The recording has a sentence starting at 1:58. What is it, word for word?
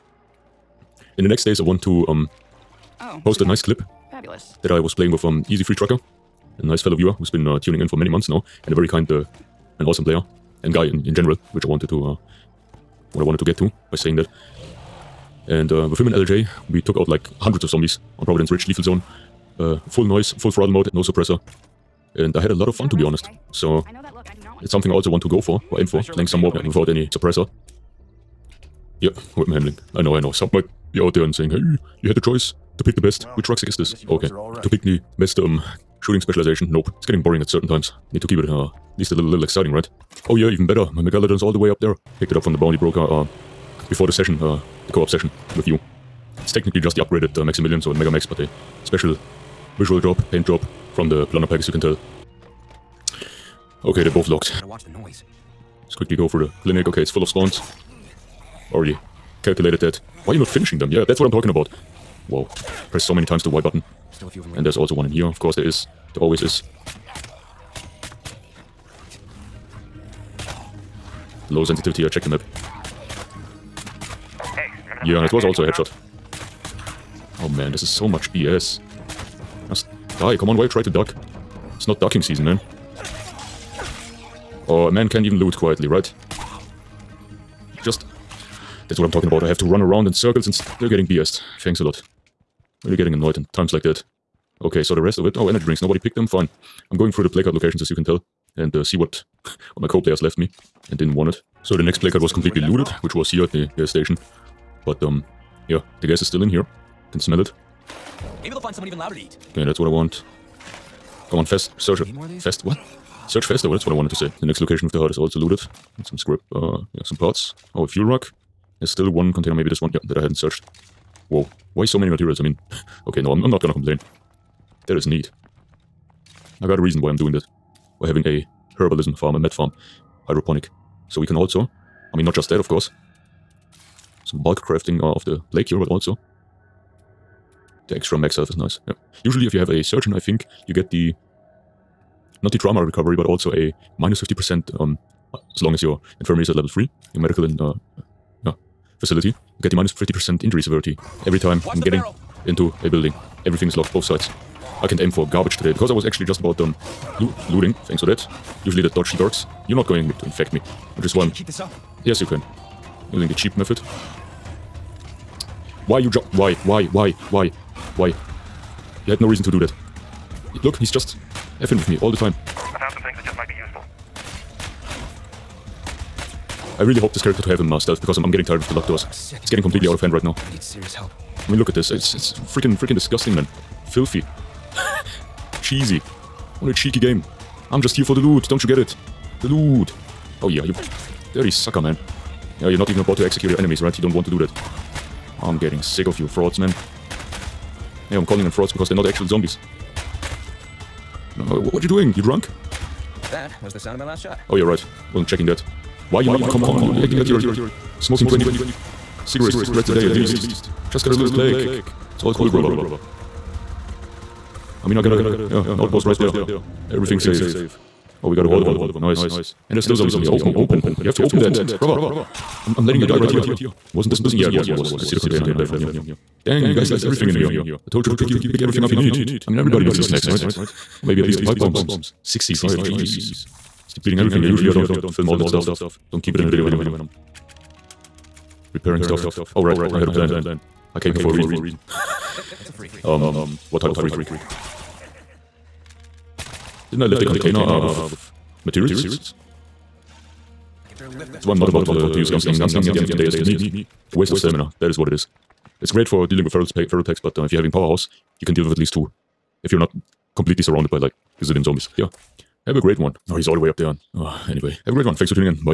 There's still one container, maybe this one, yeah, that I hadn't searched.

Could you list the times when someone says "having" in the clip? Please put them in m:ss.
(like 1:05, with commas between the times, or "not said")
2:08, 4:17.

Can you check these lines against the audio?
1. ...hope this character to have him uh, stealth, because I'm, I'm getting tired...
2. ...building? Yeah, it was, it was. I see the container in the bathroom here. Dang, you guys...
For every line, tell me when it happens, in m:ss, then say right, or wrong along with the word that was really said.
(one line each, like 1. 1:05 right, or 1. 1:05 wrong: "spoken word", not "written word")
1. 2:56 right
2. 3:44 right.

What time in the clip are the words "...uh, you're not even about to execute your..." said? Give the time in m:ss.
3:12.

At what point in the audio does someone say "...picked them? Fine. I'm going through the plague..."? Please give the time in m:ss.
1:35.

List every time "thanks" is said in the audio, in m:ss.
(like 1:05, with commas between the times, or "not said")
1:31, 2:37, 4:25.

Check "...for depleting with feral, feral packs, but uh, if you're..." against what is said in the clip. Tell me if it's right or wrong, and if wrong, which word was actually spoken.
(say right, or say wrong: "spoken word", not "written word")
wrong: "dealing", not "depleting".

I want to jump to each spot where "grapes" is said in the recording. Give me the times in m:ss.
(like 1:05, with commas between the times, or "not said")
not said.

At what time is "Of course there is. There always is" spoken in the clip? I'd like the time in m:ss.
1:05.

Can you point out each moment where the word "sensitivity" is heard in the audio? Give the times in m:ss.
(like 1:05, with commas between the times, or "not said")
1:11.